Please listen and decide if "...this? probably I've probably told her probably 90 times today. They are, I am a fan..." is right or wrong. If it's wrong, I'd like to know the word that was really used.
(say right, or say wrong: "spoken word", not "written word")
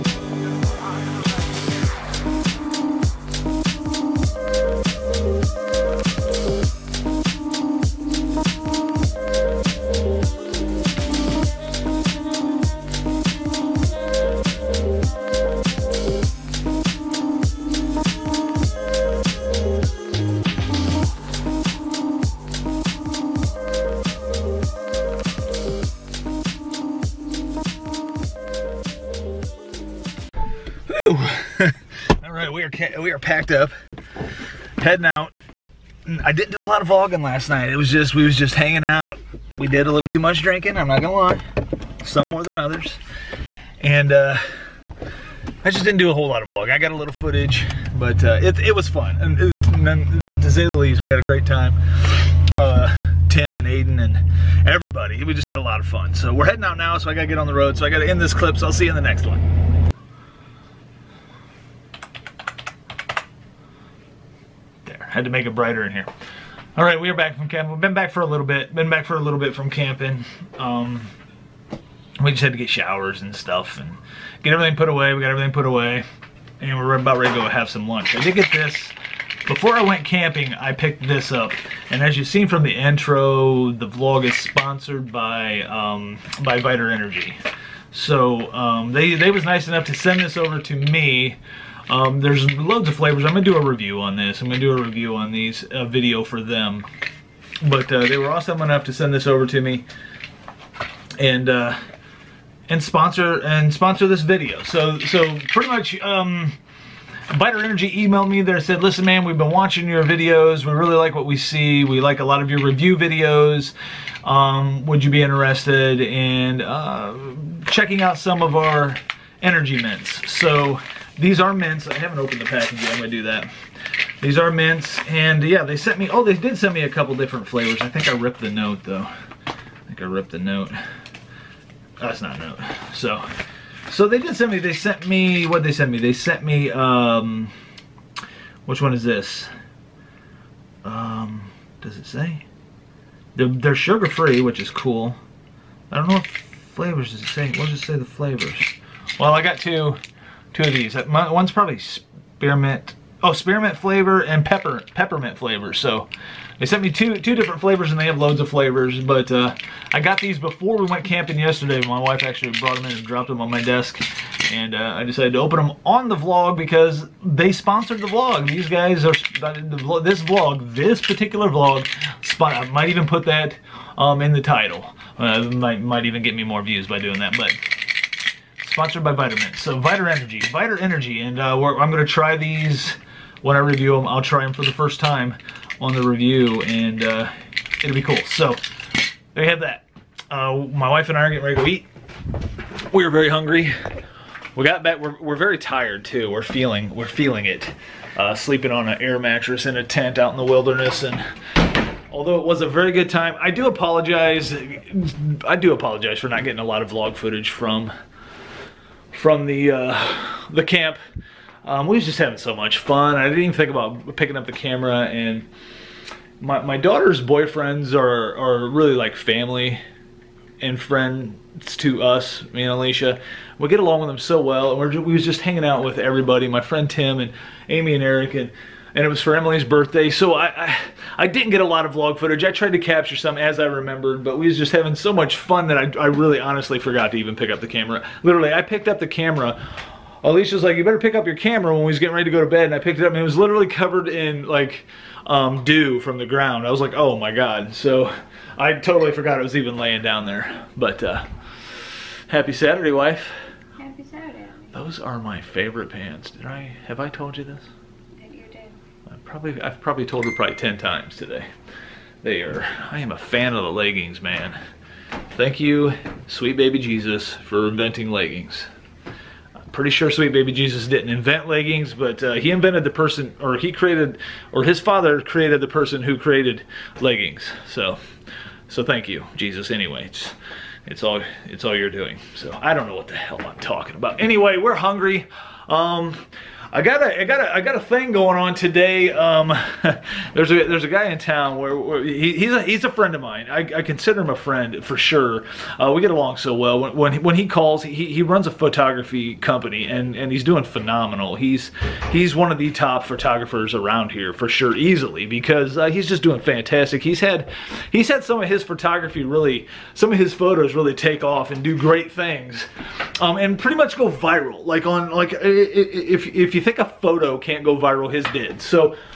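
wrong: "10", not "90".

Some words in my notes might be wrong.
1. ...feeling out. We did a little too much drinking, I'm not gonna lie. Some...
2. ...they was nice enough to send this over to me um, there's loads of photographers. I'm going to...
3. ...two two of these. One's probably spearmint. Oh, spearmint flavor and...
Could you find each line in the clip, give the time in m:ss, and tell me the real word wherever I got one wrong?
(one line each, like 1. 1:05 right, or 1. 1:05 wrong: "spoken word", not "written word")
1. 0:38 wrong: "hanging", not "feeling"
2. 1:29 wrong: "flavors", not "photographers"
3. 2:29 right.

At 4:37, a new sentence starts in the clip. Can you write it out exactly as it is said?
So, so thank you, Jesus, anyway.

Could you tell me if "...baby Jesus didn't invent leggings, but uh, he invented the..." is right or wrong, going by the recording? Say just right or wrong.
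right.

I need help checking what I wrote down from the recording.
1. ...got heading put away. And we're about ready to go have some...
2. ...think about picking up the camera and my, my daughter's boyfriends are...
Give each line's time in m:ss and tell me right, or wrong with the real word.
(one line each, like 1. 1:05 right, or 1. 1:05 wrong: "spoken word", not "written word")
1. 1:15 wrong: "everything", not "heading"
2. 3:33 right.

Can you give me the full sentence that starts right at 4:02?
And I picked it up and it was literally covered in like um, dew from the ground.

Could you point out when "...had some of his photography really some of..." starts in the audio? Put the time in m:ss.
5:08.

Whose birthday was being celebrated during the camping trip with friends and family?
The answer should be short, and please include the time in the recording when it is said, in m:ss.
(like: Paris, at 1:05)
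Emily, at 3:49.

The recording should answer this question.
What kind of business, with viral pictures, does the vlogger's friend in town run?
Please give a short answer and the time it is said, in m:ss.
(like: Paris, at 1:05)
A photography company, at 4:58.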